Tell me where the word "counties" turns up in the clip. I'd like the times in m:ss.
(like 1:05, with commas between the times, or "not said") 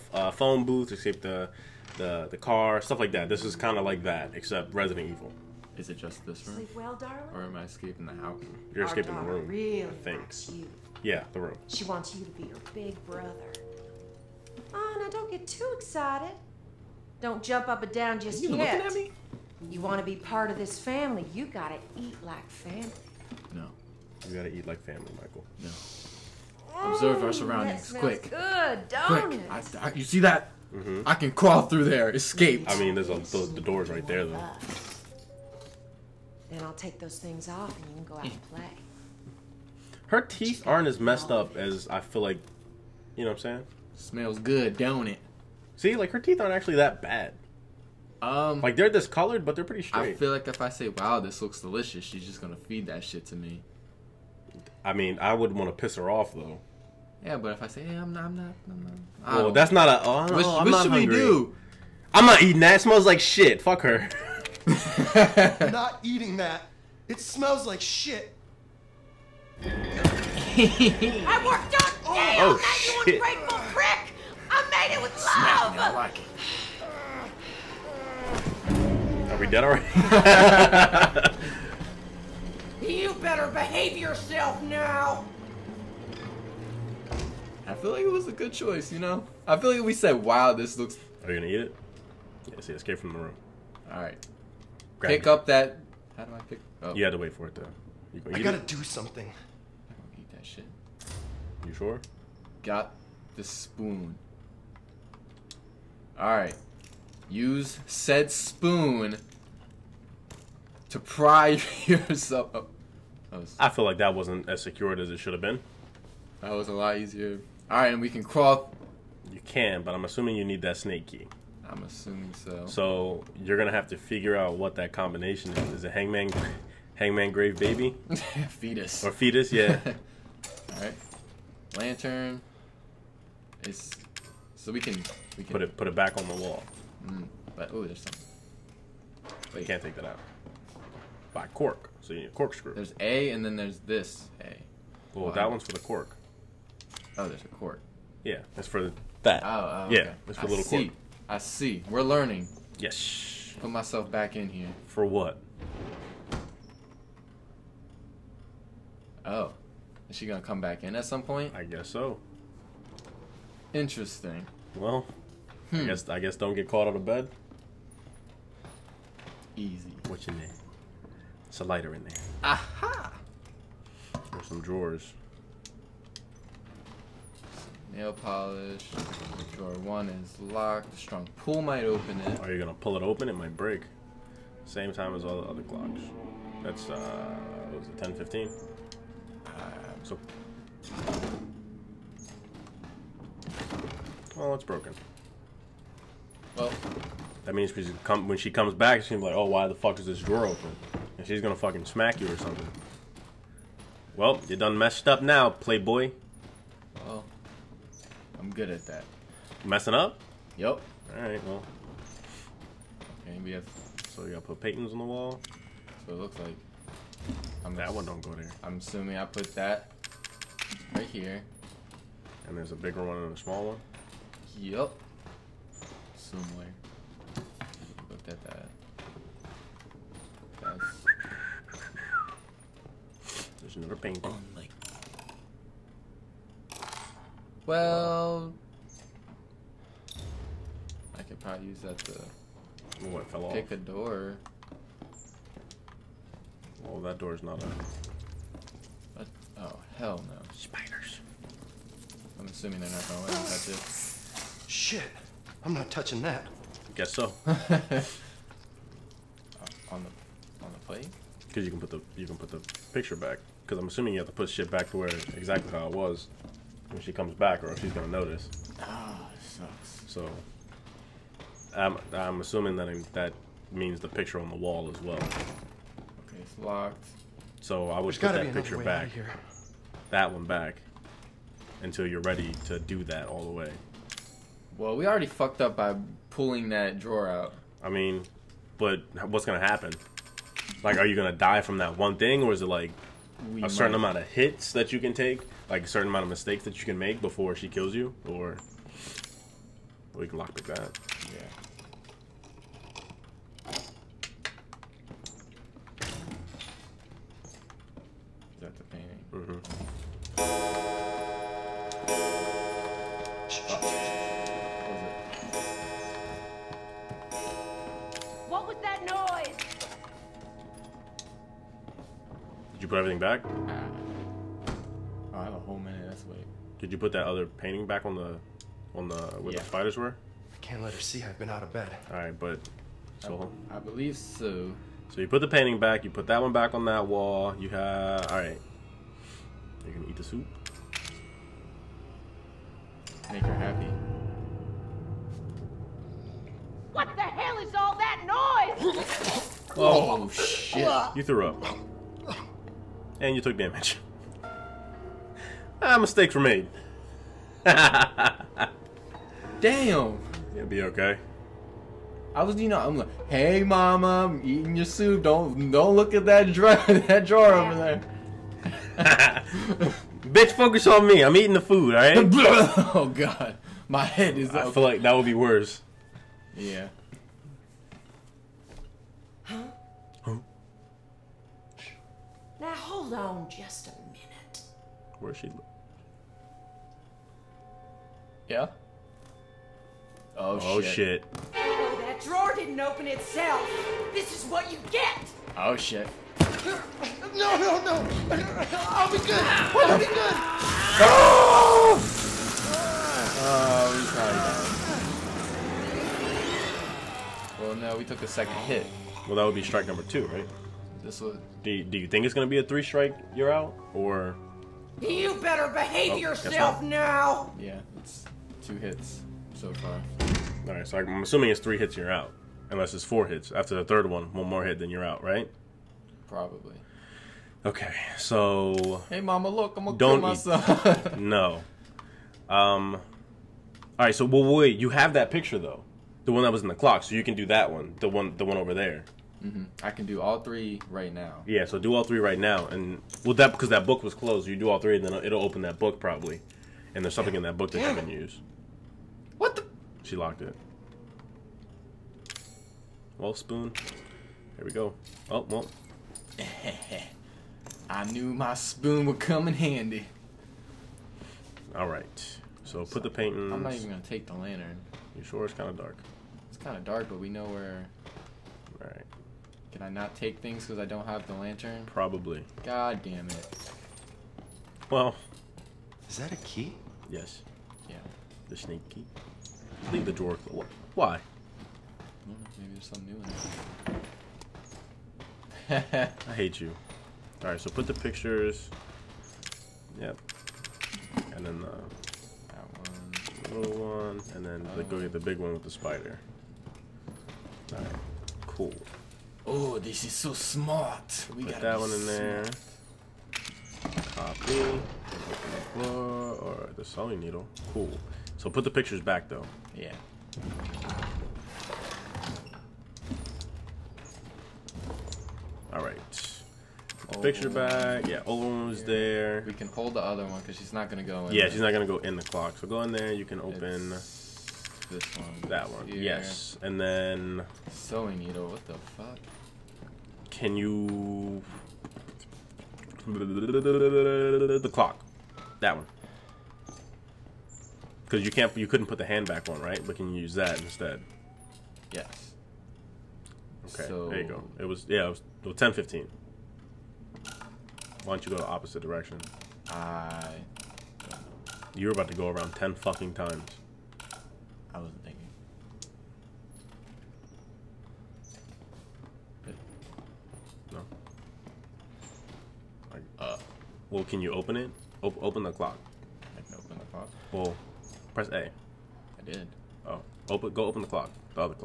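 not said.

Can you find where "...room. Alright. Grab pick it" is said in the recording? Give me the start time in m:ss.
1:33.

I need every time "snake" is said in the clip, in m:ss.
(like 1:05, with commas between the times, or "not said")
2:00, 7:58.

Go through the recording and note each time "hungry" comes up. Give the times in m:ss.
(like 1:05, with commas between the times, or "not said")
1:00.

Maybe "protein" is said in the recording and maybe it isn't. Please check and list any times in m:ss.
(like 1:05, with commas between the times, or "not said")
not said.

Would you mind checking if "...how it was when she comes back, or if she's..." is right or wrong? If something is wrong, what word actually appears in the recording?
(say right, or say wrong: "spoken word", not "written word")
right.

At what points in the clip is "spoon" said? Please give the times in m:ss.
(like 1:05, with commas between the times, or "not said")
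1:43, 1:48, 7:33, 7:38.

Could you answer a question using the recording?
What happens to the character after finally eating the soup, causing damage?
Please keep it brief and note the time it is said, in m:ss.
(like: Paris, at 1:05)
Threw up, at 5:51.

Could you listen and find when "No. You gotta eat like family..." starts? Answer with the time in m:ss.
0:23.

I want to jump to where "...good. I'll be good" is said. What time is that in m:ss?
6:39.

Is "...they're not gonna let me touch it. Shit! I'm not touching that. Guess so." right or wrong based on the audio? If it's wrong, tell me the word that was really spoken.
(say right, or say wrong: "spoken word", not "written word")
right.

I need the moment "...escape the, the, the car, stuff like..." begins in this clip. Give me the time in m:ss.
0:00.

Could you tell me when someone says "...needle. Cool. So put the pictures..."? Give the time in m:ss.
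8:27.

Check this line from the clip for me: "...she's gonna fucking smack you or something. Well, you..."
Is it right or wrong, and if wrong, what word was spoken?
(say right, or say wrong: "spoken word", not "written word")
right.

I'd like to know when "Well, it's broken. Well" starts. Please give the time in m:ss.
3:14.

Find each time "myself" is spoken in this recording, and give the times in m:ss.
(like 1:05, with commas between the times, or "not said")
2:33, 7:10.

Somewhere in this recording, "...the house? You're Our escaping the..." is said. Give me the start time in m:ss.
0:08.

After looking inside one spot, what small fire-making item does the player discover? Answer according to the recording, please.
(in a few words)
A lighter.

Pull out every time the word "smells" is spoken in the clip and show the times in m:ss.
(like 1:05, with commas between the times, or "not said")
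0:43, 1:02, 1:07.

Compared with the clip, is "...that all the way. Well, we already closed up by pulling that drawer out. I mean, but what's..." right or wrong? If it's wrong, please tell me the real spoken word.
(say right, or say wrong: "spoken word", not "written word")
wrong: "fucked", not "closed".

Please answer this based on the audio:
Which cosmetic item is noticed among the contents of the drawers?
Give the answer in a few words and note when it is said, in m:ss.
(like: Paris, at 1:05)
Nail polish, at 2:57.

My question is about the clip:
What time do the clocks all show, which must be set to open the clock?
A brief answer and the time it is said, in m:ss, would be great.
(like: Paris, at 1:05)
10:15, at 9:05.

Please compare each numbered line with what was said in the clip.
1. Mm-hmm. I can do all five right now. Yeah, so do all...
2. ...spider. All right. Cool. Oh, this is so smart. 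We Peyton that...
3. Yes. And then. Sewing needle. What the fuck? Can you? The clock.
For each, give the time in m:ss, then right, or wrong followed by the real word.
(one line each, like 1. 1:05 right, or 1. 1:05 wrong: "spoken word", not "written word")
1. 7:19 wrong: "three", not "five"
2. 8:15 wrong: "Put", not "Peyton"
3. 8:46 right.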